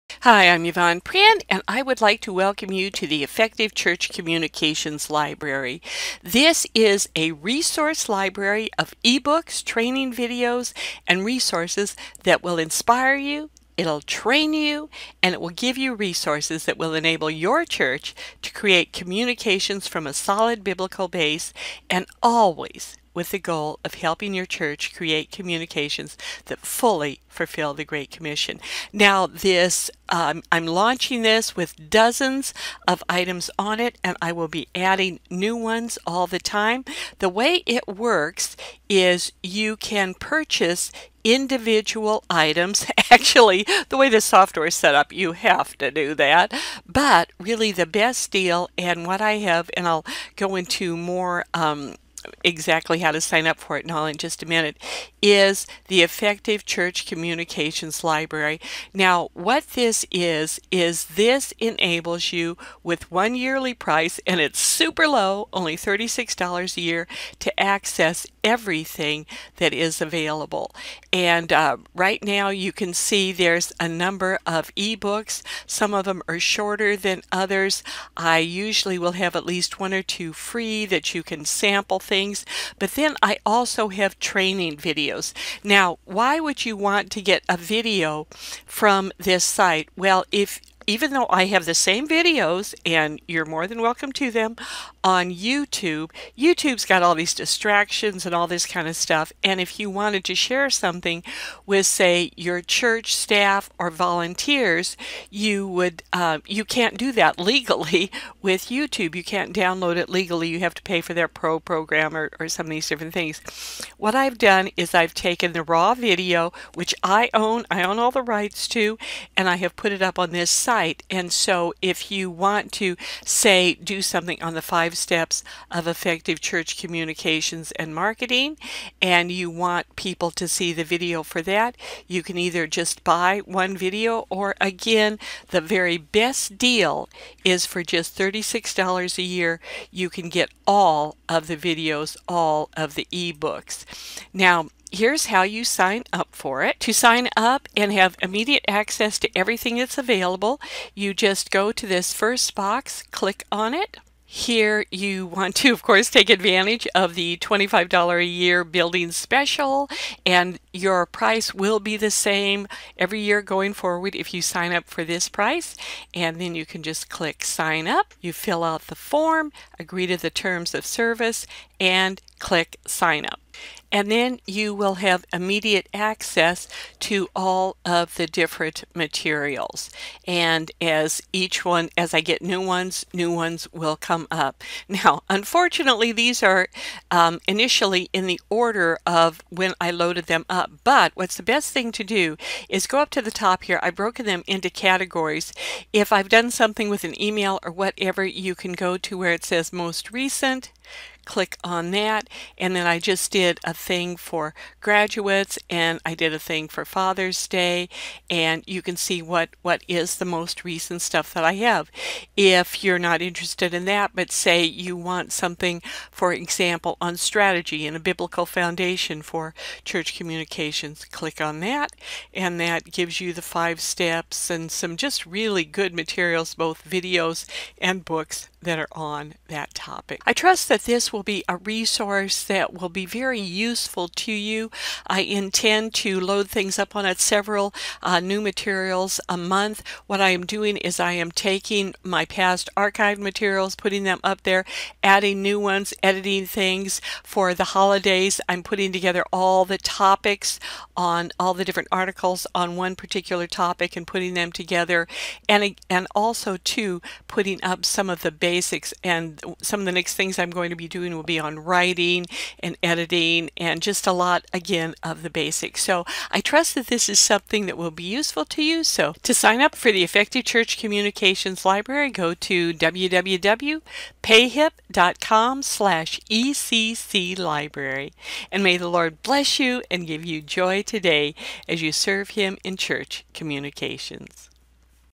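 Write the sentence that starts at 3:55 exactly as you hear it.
I intend to load things up on it several uh, new materials a month.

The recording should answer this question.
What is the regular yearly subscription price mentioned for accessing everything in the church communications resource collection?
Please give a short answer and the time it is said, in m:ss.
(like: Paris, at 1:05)
$36, at 1:05.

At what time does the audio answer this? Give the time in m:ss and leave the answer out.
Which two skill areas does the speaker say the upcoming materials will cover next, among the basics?
4:21.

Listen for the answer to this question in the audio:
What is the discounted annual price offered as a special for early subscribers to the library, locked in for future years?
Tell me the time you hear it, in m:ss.
2:37.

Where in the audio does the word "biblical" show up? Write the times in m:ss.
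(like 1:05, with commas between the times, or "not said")
0:20, 3:37.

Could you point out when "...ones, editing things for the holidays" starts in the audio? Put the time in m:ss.
4:05.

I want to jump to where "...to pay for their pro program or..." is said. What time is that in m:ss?
1:50.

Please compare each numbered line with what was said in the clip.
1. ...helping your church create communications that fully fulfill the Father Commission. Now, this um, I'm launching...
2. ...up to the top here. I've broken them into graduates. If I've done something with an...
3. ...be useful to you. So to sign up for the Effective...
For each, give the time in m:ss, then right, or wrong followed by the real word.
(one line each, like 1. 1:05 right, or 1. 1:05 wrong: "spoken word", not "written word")
1. 0:23 wrong: "Great", not "Father"
2. 3:12 wrong: "categories", not "graduates"
3. 4:27 right.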